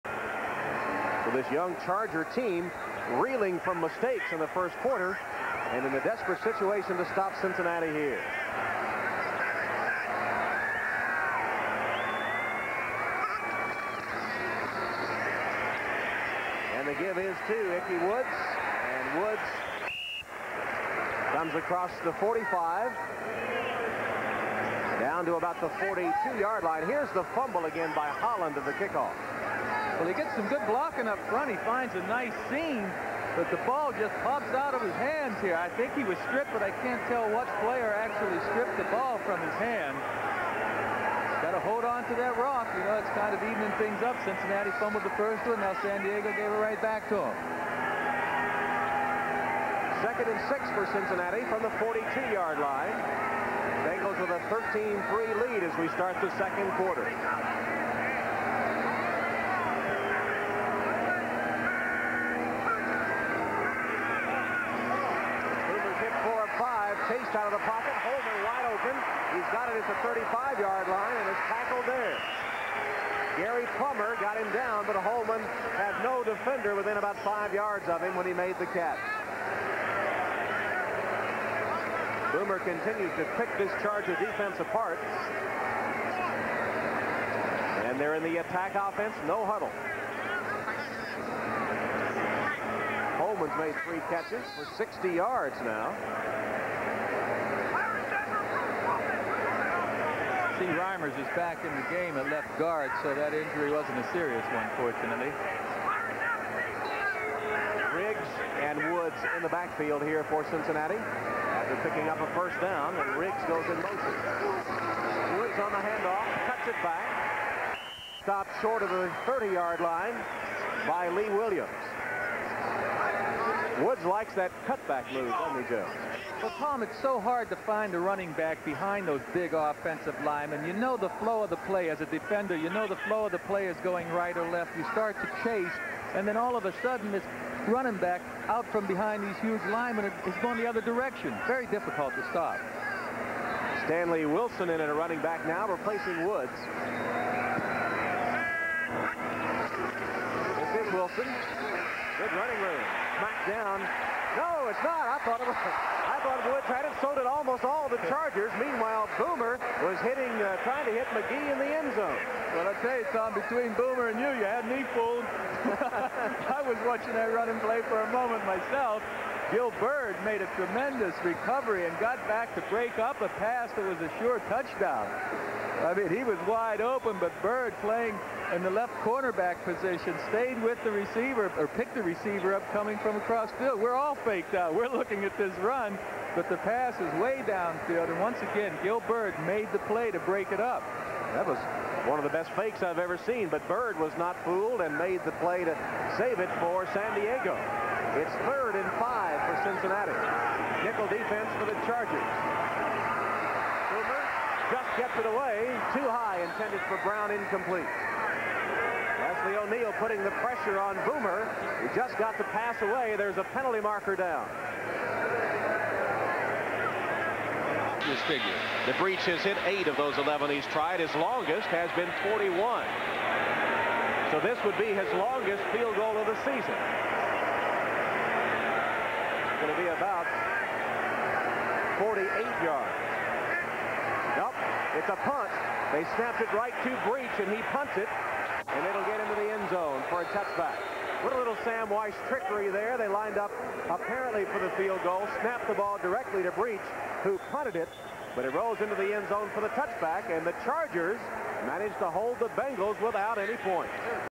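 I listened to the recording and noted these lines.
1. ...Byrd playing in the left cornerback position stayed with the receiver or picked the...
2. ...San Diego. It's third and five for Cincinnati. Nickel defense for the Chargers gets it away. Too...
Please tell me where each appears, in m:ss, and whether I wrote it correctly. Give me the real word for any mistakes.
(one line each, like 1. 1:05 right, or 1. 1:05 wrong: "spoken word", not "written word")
1. 2:57 right
2. 3:16 right.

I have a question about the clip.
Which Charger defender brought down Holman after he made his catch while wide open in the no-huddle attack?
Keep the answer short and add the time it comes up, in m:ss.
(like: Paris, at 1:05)
Gary Plummer, at 1:13.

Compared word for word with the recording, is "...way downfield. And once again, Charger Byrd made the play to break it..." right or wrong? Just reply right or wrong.
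wrong.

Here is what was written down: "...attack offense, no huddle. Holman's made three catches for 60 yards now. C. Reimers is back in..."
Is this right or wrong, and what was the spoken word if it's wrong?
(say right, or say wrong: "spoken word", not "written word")
right.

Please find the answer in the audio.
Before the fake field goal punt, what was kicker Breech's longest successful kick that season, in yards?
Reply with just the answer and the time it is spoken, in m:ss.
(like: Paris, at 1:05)
41, at 3:42.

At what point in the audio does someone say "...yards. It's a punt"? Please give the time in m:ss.
3:52.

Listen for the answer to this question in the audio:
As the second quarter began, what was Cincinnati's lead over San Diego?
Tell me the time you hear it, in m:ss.
0:54.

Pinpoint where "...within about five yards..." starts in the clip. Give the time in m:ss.
1:16.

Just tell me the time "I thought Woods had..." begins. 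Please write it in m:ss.
2:35.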